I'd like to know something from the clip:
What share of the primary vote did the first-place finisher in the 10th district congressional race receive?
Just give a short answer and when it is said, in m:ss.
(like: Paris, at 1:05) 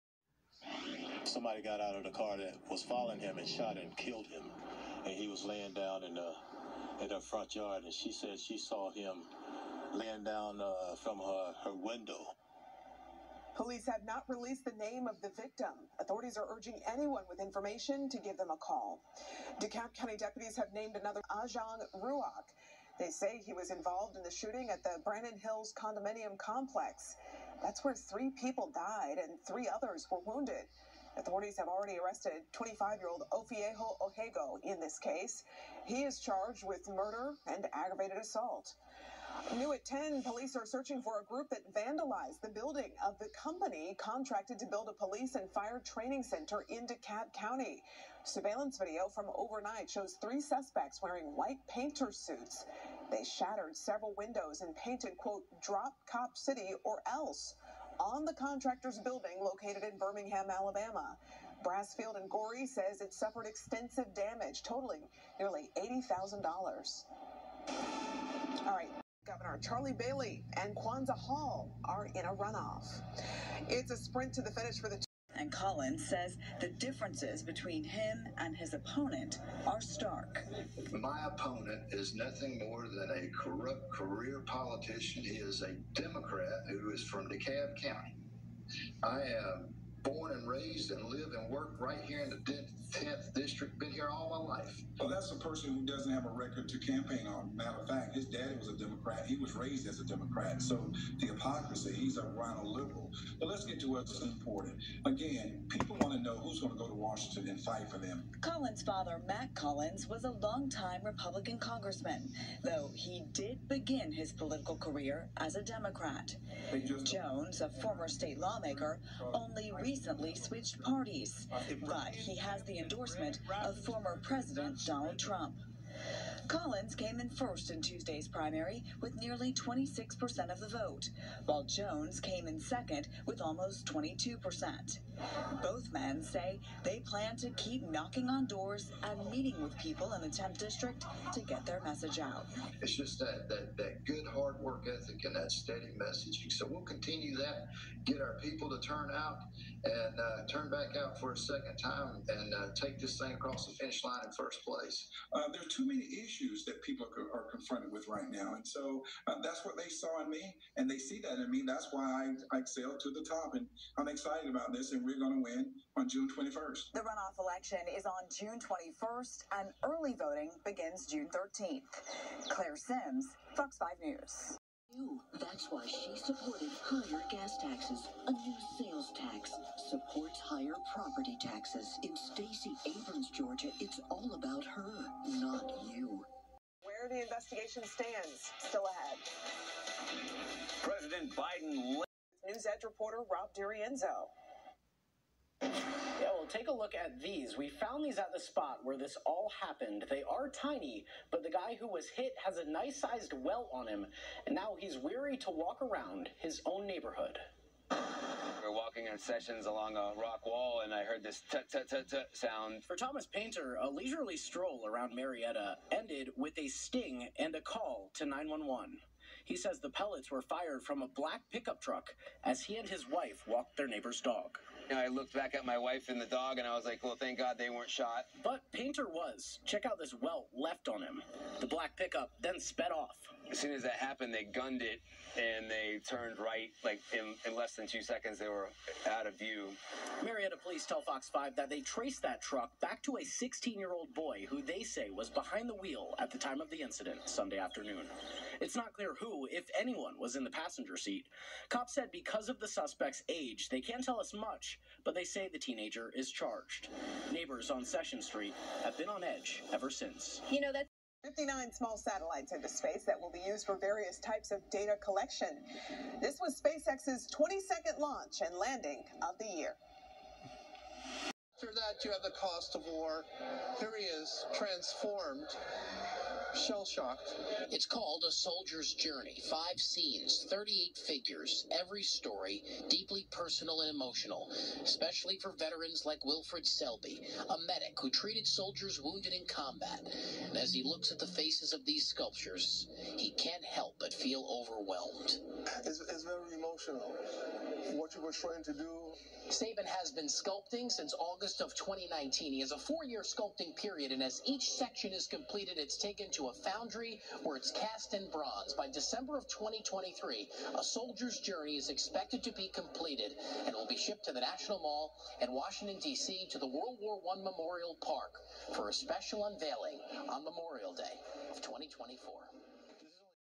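nearly 26%, at 2:09.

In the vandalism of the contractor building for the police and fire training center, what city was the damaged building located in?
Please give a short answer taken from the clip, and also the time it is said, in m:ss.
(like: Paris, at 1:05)
Birmingham, Alabama, at 0:59.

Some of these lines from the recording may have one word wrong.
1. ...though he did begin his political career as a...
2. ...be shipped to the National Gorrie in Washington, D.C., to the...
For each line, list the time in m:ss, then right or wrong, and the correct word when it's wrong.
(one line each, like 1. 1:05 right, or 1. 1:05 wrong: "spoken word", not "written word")
1. 1:52 right
2. 5:13 wrong: "Mall", not "Gorrie".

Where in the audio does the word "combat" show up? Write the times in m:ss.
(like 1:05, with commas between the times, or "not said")
4:49.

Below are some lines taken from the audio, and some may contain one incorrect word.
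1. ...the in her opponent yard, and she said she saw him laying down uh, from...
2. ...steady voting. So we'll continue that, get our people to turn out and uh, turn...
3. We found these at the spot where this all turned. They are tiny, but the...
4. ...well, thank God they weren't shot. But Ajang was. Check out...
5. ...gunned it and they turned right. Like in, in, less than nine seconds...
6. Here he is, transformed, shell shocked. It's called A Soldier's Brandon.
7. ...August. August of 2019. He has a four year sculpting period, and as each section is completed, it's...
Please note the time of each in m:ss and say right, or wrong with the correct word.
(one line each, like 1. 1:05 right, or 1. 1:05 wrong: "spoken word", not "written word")
1. 0:06 wrong: "front", not "opponent"
2. 2:25 wrong: "messaging", not "voting"
3. 3:17 wrong: "happened", not "turned"
4. 3:47 wrong: "Painter", not "Ajang"
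5. 3:54 wrong: "two", not "nine"
6. 4:33 wrong: "Journey", not "Brandon"
7. 5:01 right.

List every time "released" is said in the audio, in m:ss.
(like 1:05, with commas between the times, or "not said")
0:14.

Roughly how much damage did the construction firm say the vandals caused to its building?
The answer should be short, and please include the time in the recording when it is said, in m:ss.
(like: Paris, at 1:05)
nearly $80,000, at 1:05.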